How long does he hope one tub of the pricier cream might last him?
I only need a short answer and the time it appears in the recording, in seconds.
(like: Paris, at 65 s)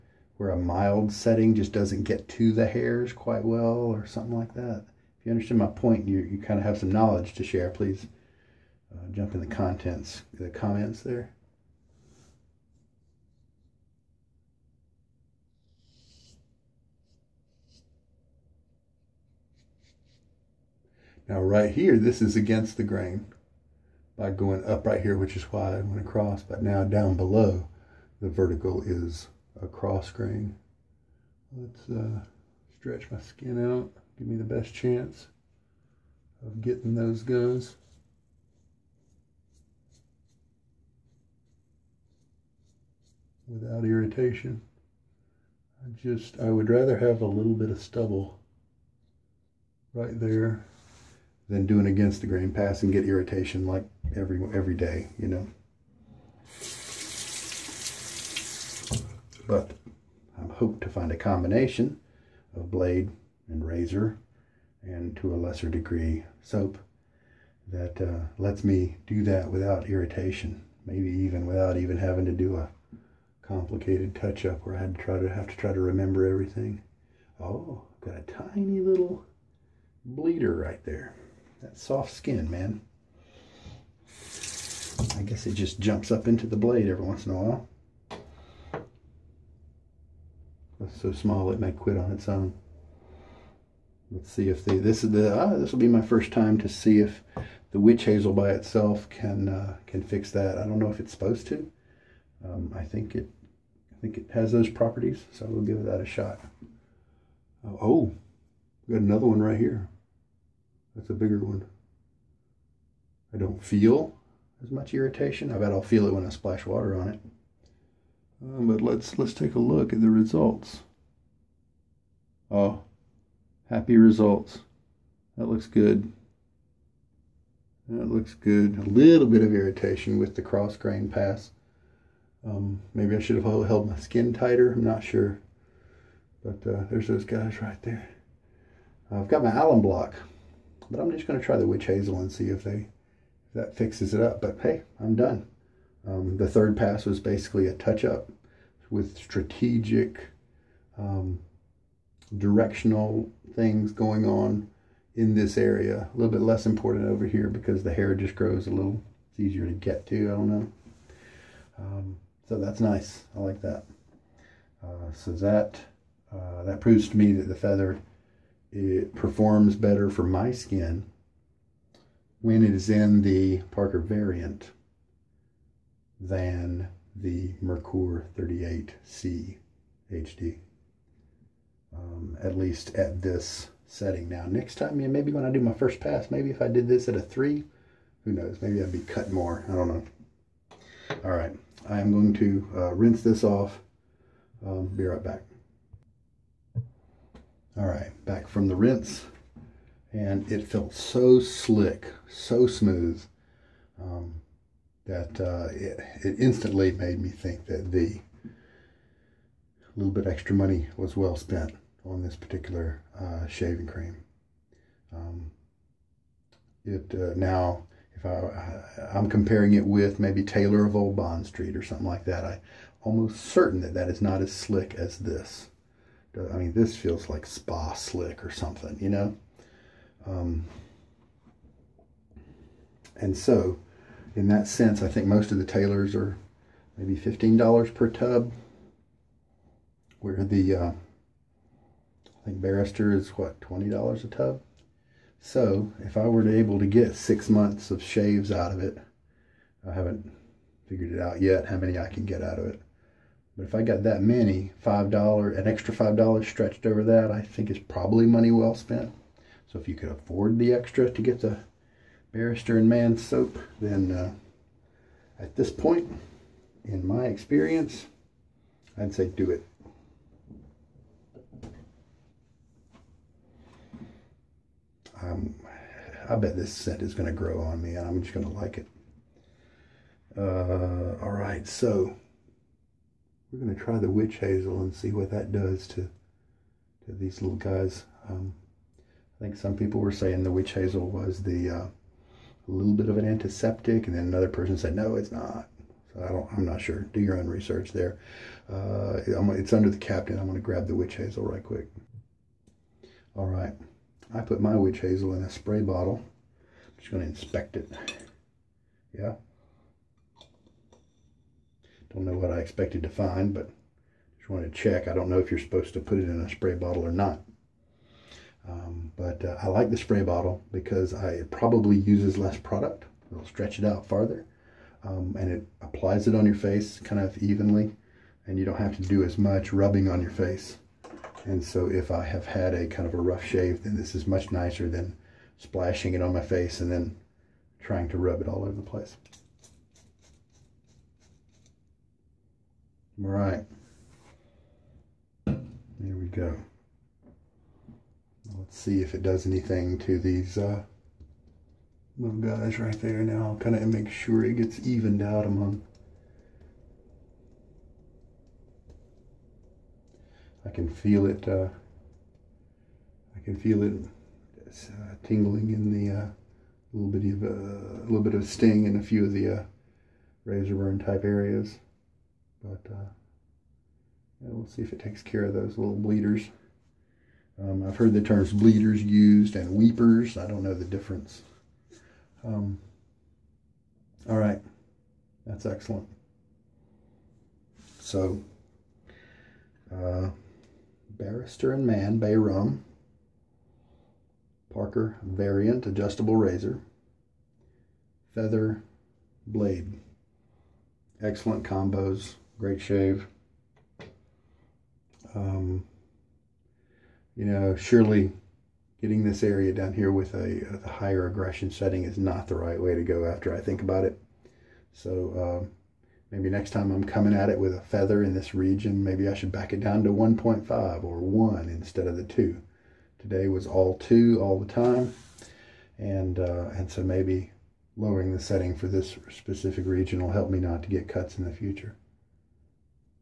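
six months, at 247 s.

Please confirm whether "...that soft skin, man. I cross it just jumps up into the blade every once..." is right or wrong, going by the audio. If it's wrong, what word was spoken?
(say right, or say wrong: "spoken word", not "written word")
wrong: "guess", not "cross".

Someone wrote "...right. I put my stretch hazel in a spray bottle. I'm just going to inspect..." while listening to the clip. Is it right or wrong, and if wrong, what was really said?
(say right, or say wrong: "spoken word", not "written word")
wrong: "witch", not "stretch".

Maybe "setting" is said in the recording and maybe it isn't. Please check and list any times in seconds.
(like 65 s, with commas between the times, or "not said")
1 s, 183 s, 411 s, 428 s.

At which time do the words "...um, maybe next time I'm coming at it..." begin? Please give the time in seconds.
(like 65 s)
415 s.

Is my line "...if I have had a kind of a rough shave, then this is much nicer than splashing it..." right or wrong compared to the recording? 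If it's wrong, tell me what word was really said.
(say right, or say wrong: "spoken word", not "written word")
right.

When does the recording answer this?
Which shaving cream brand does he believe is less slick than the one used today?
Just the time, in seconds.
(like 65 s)
220 s.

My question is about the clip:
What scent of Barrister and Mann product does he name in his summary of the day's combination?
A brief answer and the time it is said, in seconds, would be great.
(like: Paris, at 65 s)
Bay Rum, at 392 s.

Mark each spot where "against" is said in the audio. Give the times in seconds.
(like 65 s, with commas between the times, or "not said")
22 s, 51 s.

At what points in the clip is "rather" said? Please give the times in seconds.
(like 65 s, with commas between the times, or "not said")
46 s.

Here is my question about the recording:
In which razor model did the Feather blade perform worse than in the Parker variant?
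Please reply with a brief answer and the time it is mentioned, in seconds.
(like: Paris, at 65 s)
Merkur 38C HD, at 177 s.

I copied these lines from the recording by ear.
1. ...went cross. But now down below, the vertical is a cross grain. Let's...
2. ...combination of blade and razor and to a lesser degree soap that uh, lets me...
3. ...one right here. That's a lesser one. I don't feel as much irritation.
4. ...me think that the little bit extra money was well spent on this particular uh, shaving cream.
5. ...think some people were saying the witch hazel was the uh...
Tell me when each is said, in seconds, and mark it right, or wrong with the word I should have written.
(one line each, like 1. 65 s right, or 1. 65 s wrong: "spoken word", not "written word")
1. 25 s wrong: "across", not "cross"
2. 61 s right
3. 109 s wrong: "bigger", not "lesser"
4. 207 s right
5. 289 s right.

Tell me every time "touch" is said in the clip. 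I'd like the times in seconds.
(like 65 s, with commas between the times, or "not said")
74 s, 147 s.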